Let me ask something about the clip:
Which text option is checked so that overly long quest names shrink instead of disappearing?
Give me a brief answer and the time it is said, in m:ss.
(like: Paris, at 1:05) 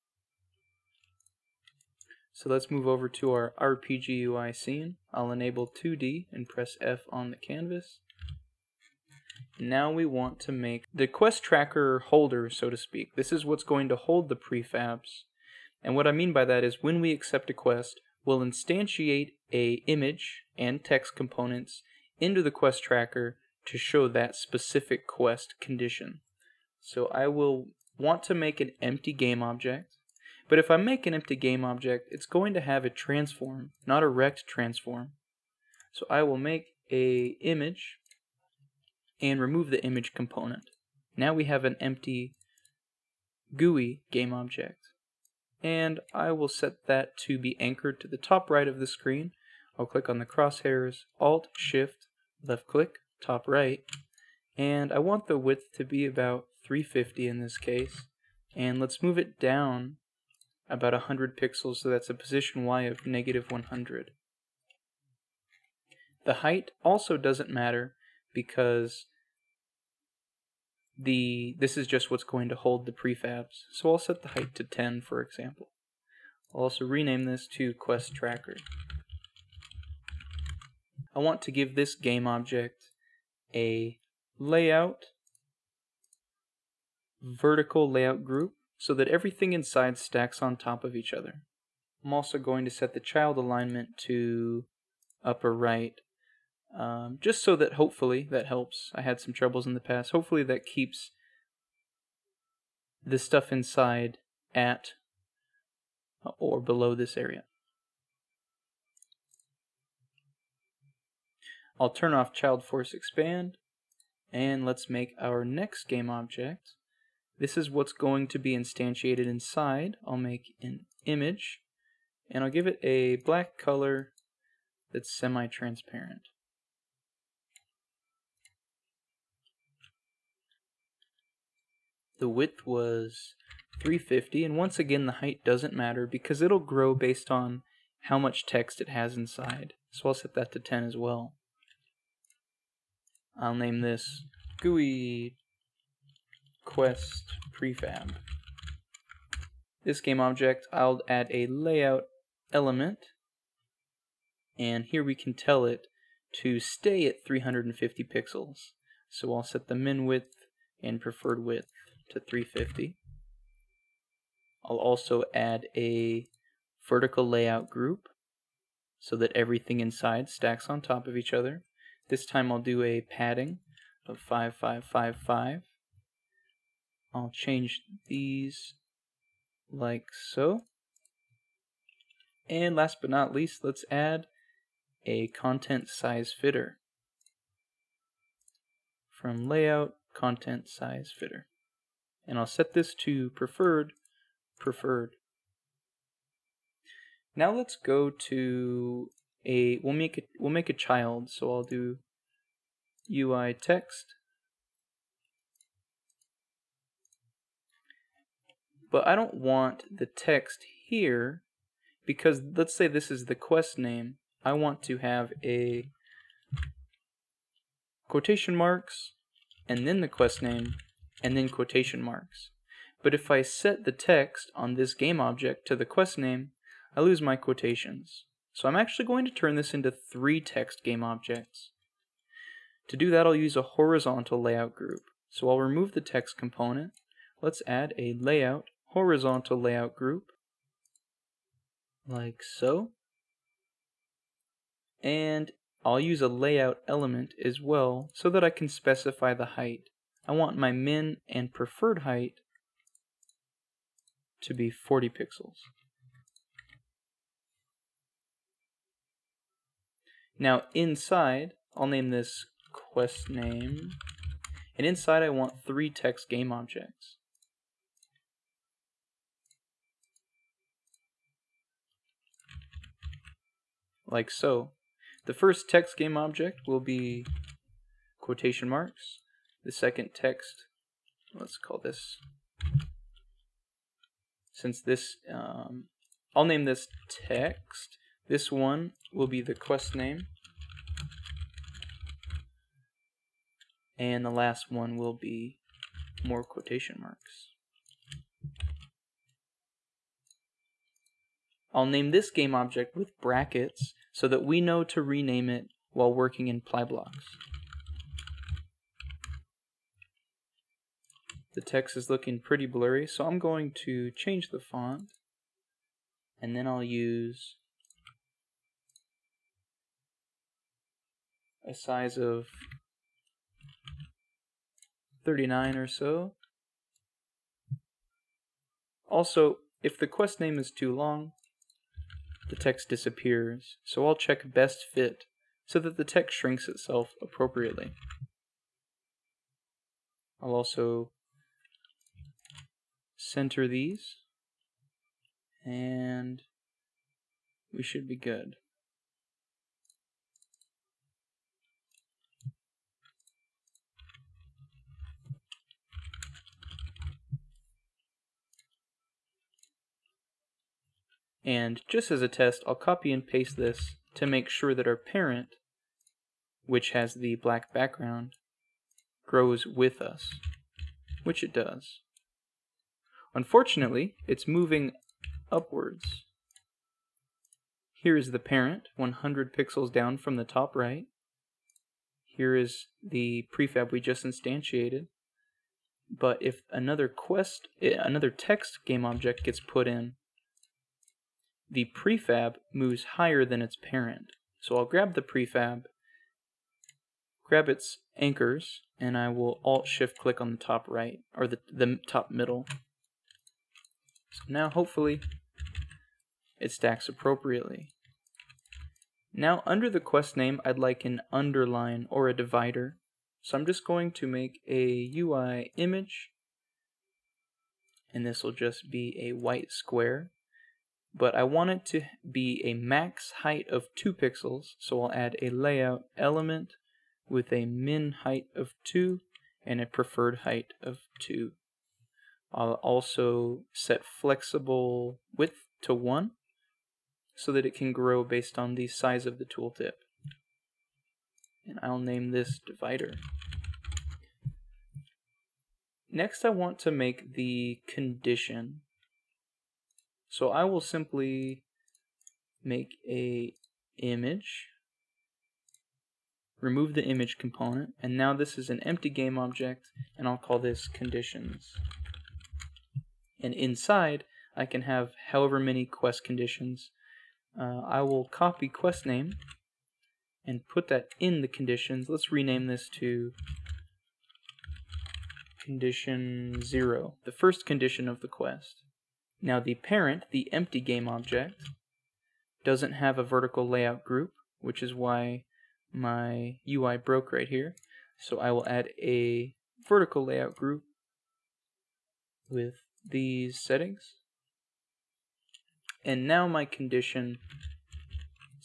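best fit, at 5:34.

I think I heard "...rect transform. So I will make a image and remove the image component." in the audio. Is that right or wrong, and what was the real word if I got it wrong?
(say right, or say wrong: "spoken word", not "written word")
right.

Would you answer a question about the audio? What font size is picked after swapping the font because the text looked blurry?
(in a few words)
39.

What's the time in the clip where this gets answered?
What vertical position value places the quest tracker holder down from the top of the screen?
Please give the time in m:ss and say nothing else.
1:03.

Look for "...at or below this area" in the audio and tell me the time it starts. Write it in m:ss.
1:44.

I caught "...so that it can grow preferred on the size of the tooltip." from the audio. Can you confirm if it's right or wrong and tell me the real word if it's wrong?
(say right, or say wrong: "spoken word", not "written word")
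wrong: "based", not "preferred".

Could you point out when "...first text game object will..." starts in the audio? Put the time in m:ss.
4:35.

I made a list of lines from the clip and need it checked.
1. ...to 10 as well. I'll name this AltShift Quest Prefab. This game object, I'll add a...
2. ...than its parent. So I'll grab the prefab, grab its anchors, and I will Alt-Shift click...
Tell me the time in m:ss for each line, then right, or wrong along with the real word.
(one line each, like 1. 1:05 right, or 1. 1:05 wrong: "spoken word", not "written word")
1. 2:20 wrong: "GUI", not "AltShift"
2. 6:33 right.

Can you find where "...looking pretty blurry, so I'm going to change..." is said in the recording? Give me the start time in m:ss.
5:12.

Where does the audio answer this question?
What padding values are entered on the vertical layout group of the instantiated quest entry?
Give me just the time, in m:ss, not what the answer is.
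2:54.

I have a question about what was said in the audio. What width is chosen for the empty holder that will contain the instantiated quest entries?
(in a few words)
350.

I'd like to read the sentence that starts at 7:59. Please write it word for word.
Now the parent, the empty game object, doesn't have a vertical layout group, which is why my UI broke right here.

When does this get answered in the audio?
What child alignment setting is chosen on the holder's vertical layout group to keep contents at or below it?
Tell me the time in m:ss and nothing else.
1:35.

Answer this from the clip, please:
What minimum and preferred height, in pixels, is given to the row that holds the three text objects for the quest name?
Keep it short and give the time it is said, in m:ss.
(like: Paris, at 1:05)
40 pixels, at 4:14.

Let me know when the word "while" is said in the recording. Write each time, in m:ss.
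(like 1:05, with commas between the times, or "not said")
5:05.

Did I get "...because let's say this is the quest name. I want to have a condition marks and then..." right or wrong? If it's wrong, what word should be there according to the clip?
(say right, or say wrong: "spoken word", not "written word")
wrong: "quotation", not "condition".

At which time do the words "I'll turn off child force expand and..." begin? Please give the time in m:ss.
1:51.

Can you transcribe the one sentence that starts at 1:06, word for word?
The height also doesn't matter because the this is just what's going to hold the prefabs.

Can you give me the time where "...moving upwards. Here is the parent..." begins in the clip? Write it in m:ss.
6:14.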